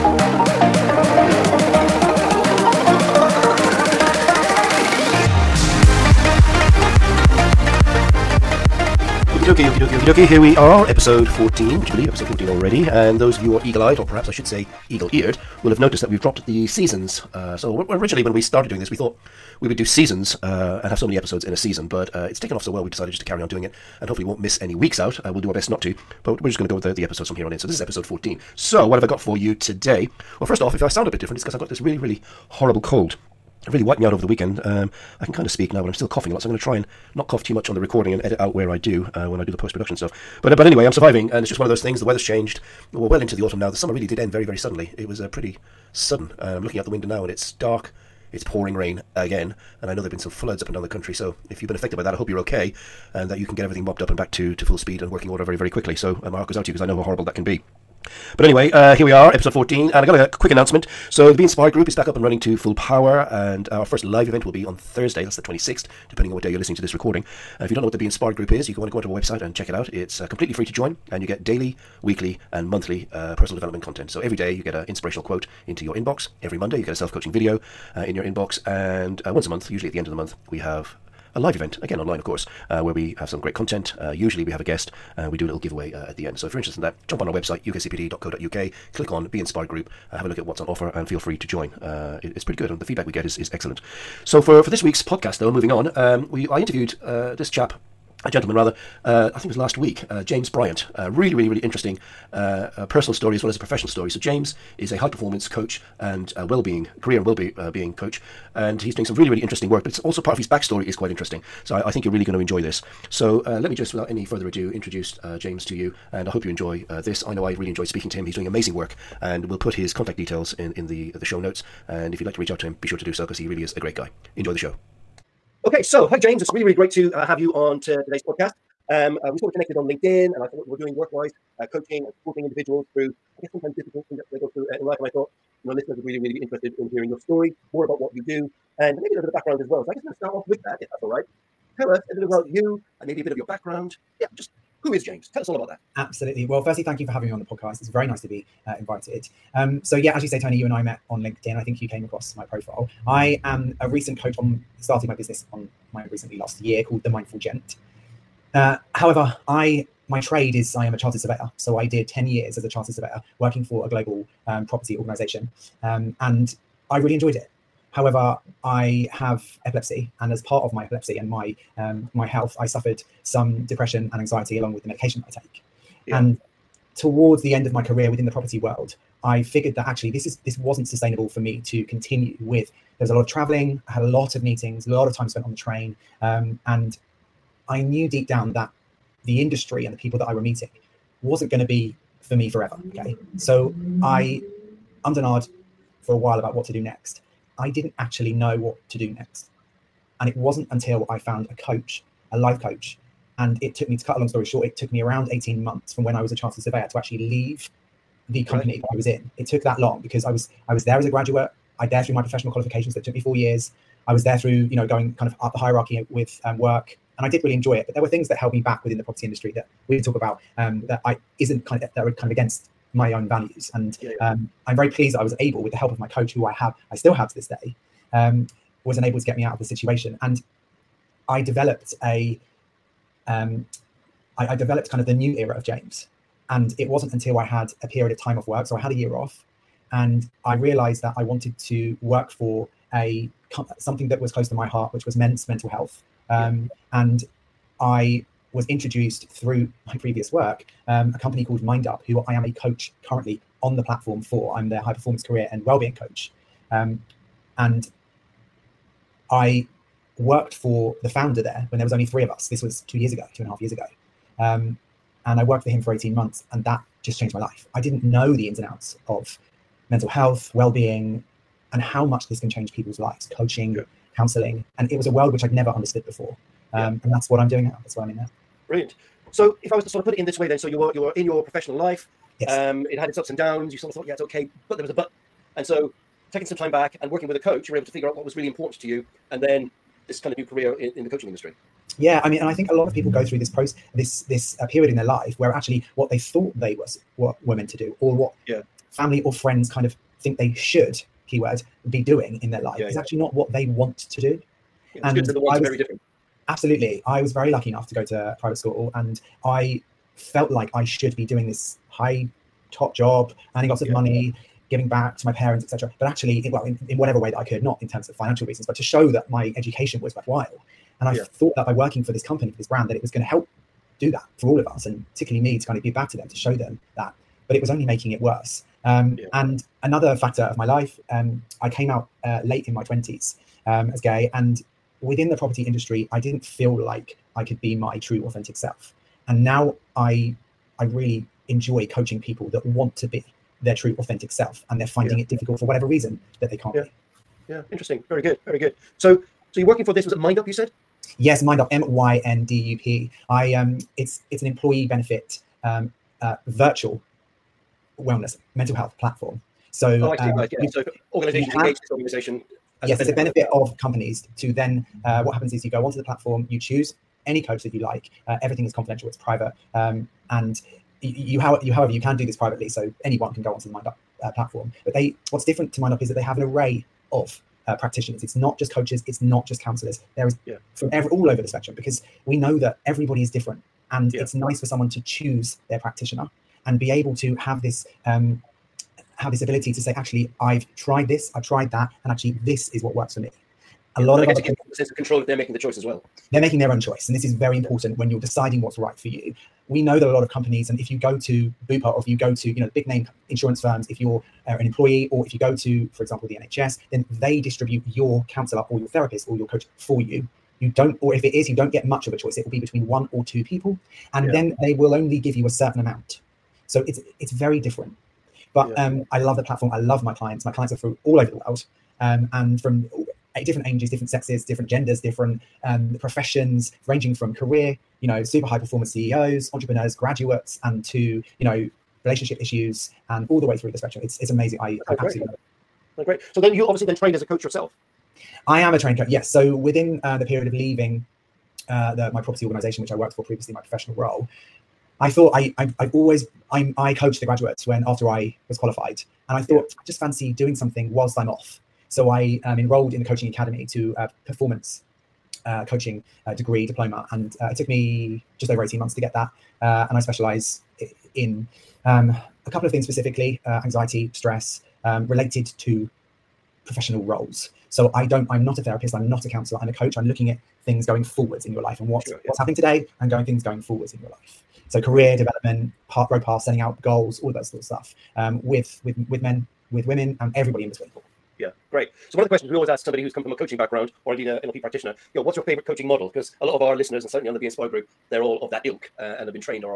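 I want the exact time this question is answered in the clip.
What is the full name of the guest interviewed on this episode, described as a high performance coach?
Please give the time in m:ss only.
1:40.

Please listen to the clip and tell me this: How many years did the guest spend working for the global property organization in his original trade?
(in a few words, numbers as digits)
10.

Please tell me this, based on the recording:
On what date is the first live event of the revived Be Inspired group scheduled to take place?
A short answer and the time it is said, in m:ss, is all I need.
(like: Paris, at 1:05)
Thursday the 26th, at 1:04.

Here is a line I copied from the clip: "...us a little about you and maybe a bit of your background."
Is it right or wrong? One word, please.
right.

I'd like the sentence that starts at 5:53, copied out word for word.
I um, it's it's an employee benefit um, uh, virtual wellness mental health platform.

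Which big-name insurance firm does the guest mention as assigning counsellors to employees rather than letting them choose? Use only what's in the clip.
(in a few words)
Bupa.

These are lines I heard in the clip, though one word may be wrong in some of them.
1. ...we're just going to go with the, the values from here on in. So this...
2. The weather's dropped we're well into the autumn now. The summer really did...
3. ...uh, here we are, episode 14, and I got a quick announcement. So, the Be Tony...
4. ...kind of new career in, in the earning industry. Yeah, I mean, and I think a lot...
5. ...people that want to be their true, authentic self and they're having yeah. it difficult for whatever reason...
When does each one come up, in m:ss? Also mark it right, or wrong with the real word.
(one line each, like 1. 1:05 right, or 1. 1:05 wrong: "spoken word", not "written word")
1. 0:26 wrong: "episodes", not "values"
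2. 0:41 wrong: "changed", not "dropped"
3. 0:58 wrong: "Inspired", not "Tony"
4. 4:50 wrong: "coaching", not "earning"
5. 5:42 wrong: "finding", not "having".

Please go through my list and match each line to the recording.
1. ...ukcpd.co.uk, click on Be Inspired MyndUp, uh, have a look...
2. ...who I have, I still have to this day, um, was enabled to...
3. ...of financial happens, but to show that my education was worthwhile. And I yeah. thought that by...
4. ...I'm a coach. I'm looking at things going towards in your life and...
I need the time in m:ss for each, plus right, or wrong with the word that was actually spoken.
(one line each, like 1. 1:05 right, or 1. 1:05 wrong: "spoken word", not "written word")
1. 1:27 wrong: "Group", not "MyndUp"
2. 3:46 right
3. 5:18 wrong: "reasons", not "happens"
4. 7:49 wrong: "forwards", not "towards".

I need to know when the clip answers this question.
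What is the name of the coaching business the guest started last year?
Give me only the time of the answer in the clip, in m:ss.
2:37.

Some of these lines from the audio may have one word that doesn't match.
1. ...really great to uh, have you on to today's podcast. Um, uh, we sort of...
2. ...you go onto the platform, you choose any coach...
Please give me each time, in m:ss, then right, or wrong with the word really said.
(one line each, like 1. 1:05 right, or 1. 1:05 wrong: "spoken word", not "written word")
1. 2:06 right
2. 6:05 right.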